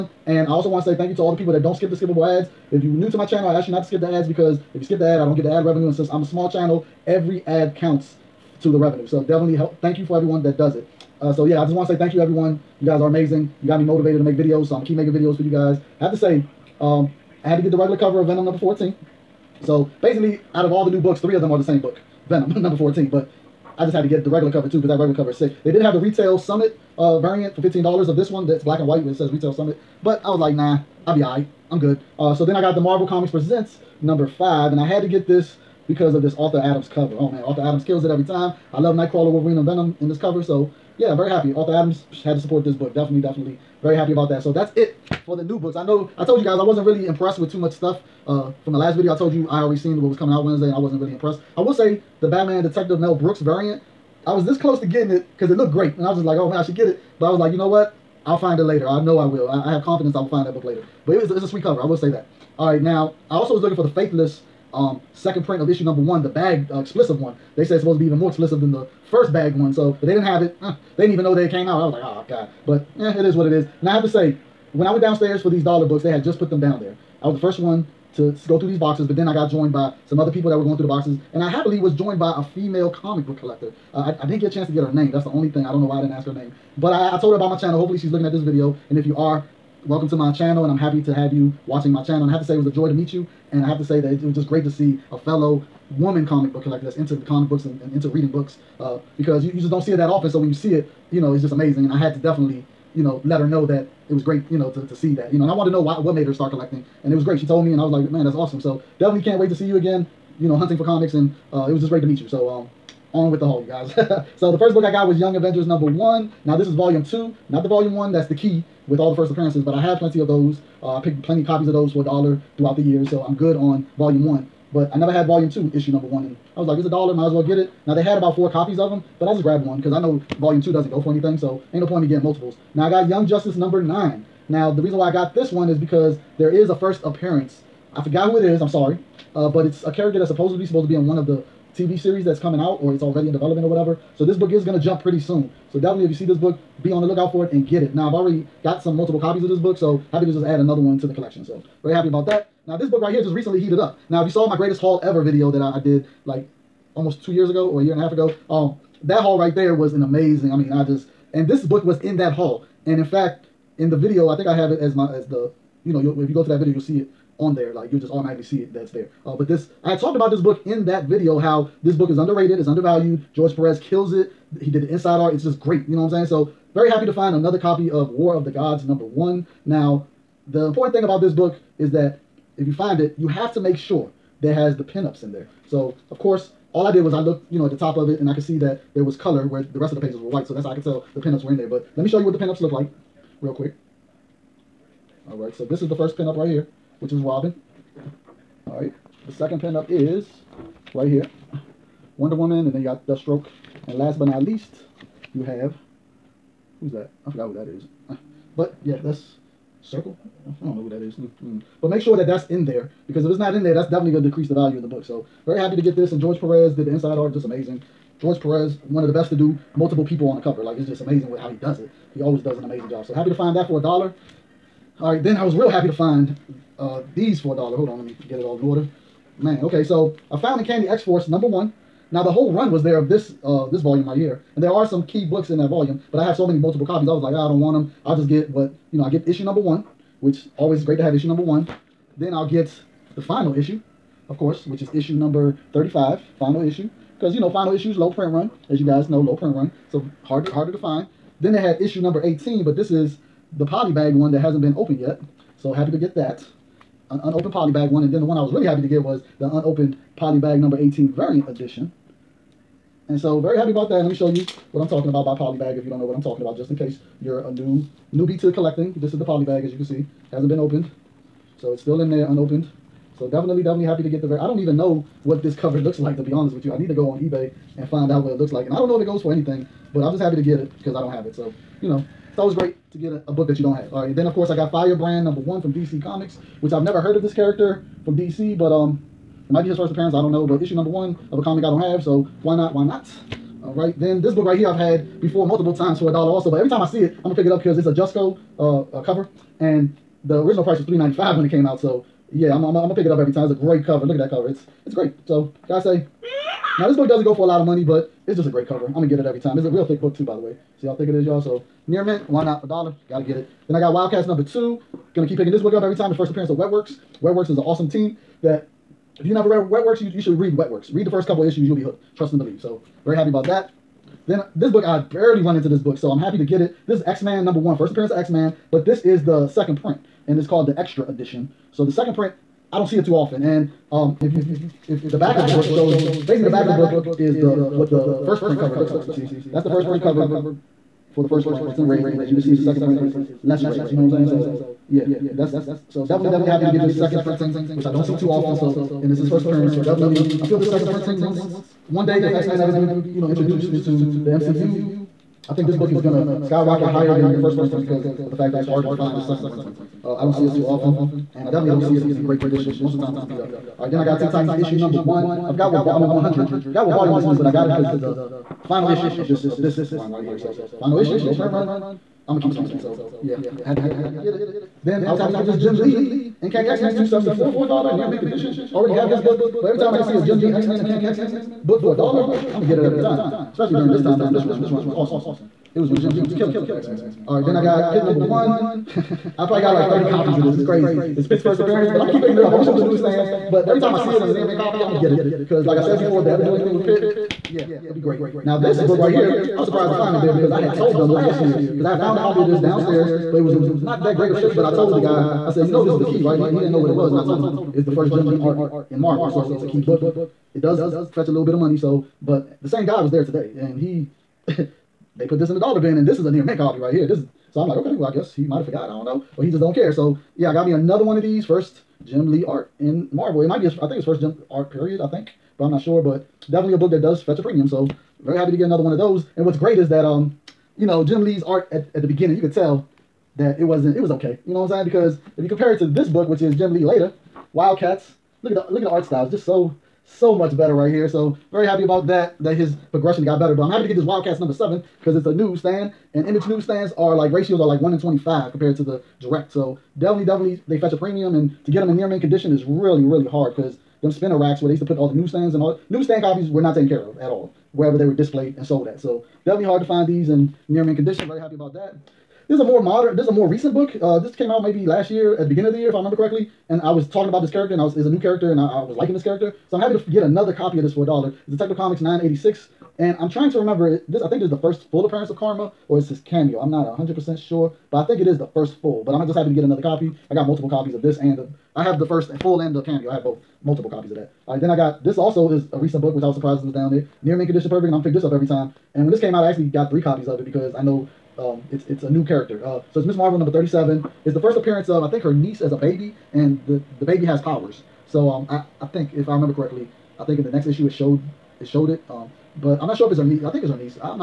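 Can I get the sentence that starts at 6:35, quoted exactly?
Because, like I said before, if they ever do anything with Pitt, yeah, it'll be great.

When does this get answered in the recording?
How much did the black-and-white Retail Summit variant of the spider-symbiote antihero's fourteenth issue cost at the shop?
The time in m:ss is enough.
0:27.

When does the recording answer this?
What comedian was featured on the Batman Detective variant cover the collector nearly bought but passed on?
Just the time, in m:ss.
0:52.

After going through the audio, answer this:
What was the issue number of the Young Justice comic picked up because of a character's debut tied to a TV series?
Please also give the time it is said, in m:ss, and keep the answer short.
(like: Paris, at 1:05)
9, at 2:13.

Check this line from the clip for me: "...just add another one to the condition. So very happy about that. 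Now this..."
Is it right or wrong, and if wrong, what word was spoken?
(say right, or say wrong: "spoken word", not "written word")
wrong: "collection", not "condition".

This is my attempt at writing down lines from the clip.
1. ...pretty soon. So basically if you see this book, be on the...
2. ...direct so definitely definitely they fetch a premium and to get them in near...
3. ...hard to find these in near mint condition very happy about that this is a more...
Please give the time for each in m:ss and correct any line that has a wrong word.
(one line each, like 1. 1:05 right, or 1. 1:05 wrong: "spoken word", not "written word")
1. 2:25 wrong: "definitely", not "basically"
2. 7:29 right
3. 7:39 right.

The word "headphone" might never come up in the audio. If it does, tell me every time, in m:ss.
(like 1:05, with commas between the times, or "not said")
not said.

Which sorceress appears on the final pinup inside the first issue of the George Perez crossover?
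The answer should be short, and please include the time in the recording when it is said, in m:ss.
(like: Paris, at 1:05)
Circe, at 3:29.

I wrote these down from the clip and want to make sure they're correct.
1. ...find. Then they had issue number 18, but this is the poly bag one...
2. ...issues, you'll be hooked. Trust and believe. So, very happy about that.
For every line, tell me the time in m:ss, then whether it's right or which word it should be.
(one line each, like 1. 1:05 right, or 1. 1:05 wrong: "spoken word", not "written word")
1. 4:10 right
2. 5:21 right.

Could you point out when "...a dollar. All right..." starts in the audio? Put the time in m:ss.
3:43.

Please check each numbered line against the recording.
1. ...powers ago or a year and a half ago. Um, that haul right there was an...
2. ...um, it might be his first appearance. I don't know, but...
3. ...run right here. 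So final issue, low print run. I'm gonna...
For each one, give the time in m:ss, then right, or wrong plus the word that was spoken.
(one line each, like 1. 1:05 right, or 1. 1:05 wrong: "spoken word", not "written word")
1. 2:37 wrong: "years", not "powers"
2. 4:48 right
3. 6:09 right.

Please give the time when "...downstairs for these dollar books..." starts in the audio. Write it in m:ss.
1:15.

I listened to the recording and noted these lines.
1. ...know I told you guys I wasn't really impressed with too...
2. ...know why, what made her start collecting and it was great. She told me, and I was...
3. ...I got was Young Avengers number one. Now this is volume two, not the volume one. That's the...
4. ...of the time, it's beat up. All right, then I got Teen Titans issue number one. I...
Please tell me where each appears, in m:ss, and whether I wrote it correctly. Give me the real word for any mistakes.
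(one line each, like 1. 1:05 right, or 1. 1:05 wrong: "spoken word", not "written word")
1. 0:45 right
2. 1:45 right
3. 1:54 right
4. 6:02 right.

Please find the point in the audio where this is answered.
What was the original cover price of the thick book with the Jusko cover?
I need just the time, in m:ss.
5:00.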